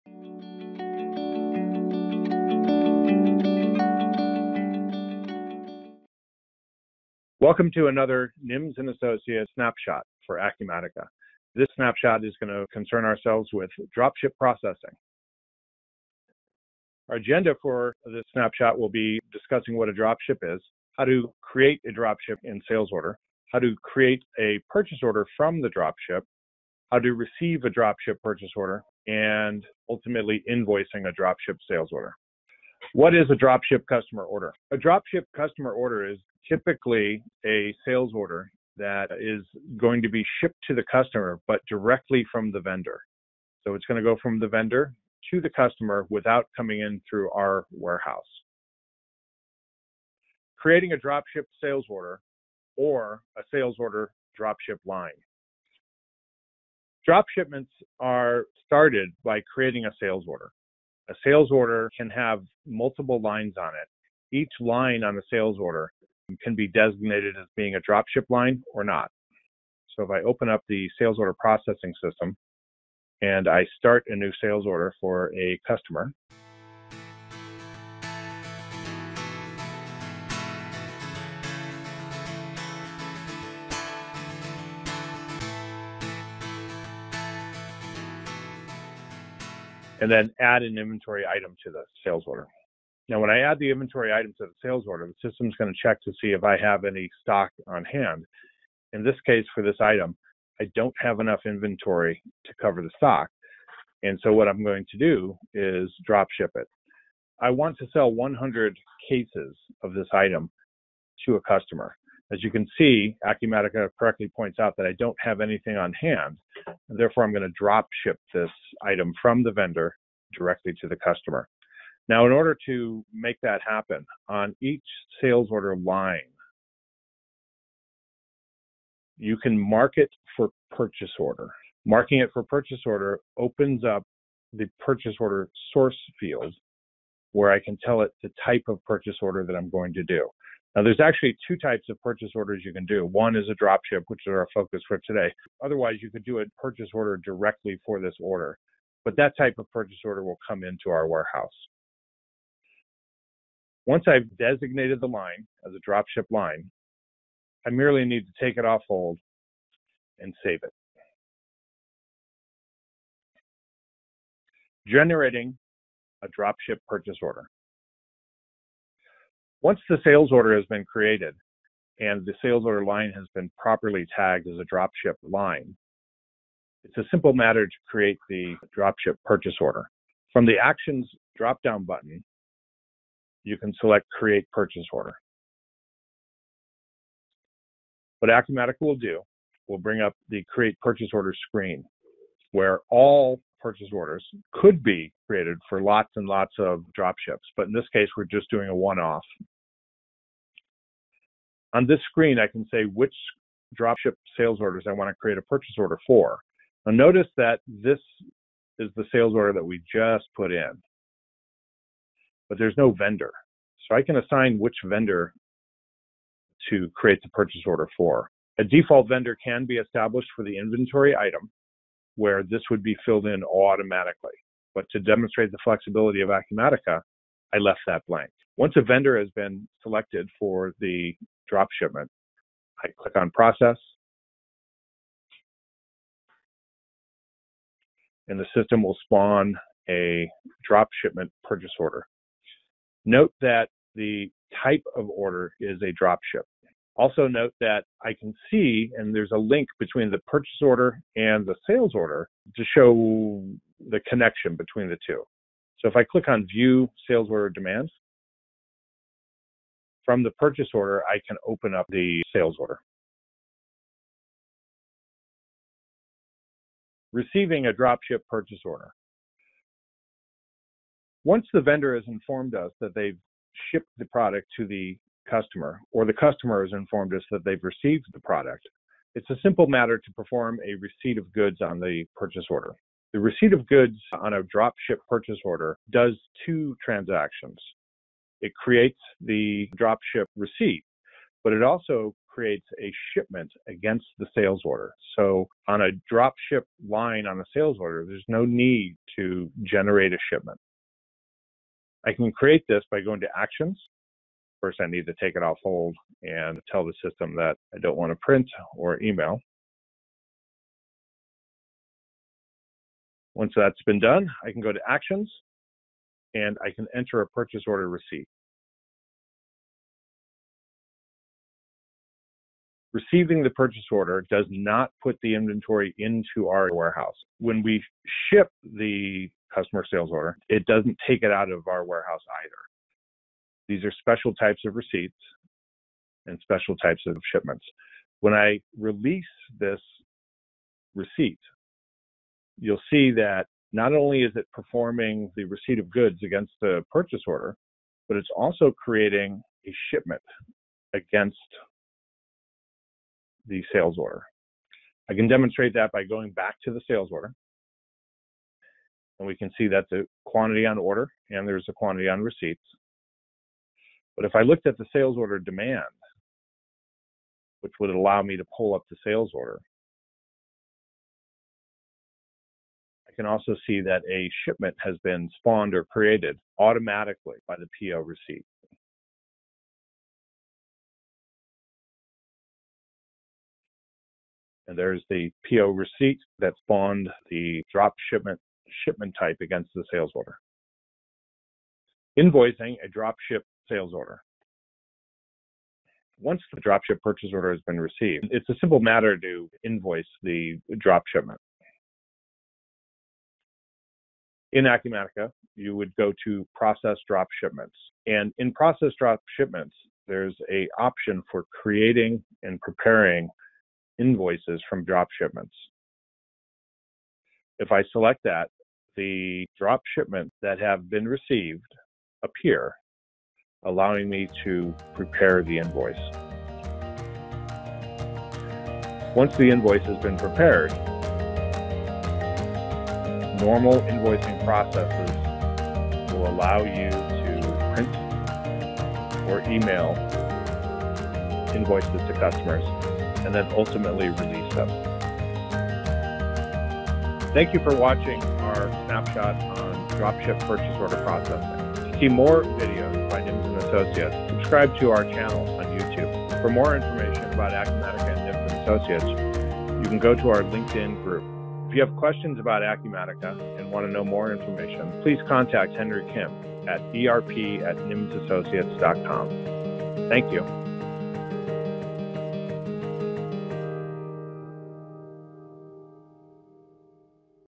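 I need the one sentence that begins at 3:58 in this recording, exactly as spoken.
And the system will spawn a drop shipment purchase order.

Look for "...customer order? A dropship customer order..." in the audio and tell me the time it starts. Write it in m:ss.
0:33.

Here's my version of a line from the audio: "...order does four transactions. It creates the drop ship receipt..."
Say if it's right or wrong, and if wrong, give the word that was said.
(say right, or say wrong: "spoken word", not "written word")
wrong: "two", not "four".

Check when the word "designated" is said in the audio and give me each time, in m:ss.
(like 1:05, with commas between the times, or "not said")
1:06, 2:34.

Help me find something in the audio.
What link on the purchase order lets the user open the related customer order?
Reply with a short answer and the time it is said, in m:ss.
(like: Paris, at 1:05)
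View sales order demands, at 4:16.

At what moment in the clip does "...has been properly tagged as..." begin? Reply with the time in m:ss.
2:53.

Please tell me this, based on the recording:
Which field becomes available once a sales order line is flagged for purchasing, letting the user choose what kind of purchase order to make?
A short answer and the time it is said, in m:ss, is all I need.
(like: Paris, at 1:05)
Purchase order source, at 2:14.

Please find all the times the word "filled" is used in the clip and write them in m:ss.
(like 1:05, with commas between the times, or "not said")
3:43.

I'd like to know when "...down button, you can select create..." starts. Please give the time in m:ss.
3:01.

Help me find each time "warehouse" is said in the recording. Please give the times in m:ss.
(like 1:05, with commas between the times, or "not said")
0:47, 2:31, 5:26, 5:31.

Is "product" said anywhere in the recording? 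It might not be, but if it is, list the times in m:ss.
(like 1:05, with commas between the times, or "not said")
4:34, 4:38.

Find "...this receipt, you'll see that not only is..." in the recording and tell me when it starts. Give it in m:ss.
5:39.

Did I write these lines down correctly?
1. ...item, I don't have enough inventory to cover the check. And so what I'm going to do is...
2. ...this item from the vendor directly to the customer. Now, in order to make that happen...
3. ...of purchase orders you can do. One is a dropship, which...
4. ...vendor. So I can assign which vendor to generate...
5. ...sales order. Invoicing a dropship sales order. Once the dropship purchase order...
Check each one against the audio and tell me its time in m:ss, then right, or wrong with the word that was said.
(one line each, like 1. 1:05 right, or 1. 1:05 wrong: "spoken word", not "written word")
1. 1:39 wrong: "stock", not "check"
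2. 1:58 right
3. 2:21 right
4. 3:32 wrong: "create", not "generate"
5. 6:29 right.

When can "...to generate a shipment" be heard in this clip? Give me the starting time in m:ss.
4:59.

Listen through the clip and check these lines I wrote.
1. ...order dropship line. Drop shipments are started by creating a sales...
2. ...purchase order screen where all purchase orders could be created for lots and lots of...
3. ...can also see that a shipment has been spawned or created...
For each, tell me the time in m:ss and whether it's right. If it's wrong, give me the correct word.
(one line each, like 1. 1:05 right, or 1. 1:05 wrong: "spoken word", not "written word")
1. 0:53 right
2. 3:10 right
3. 6:13 right.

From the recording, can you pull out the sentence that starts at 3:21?
On this screen, I can say which dropship sales orders I want to create a purchase order for.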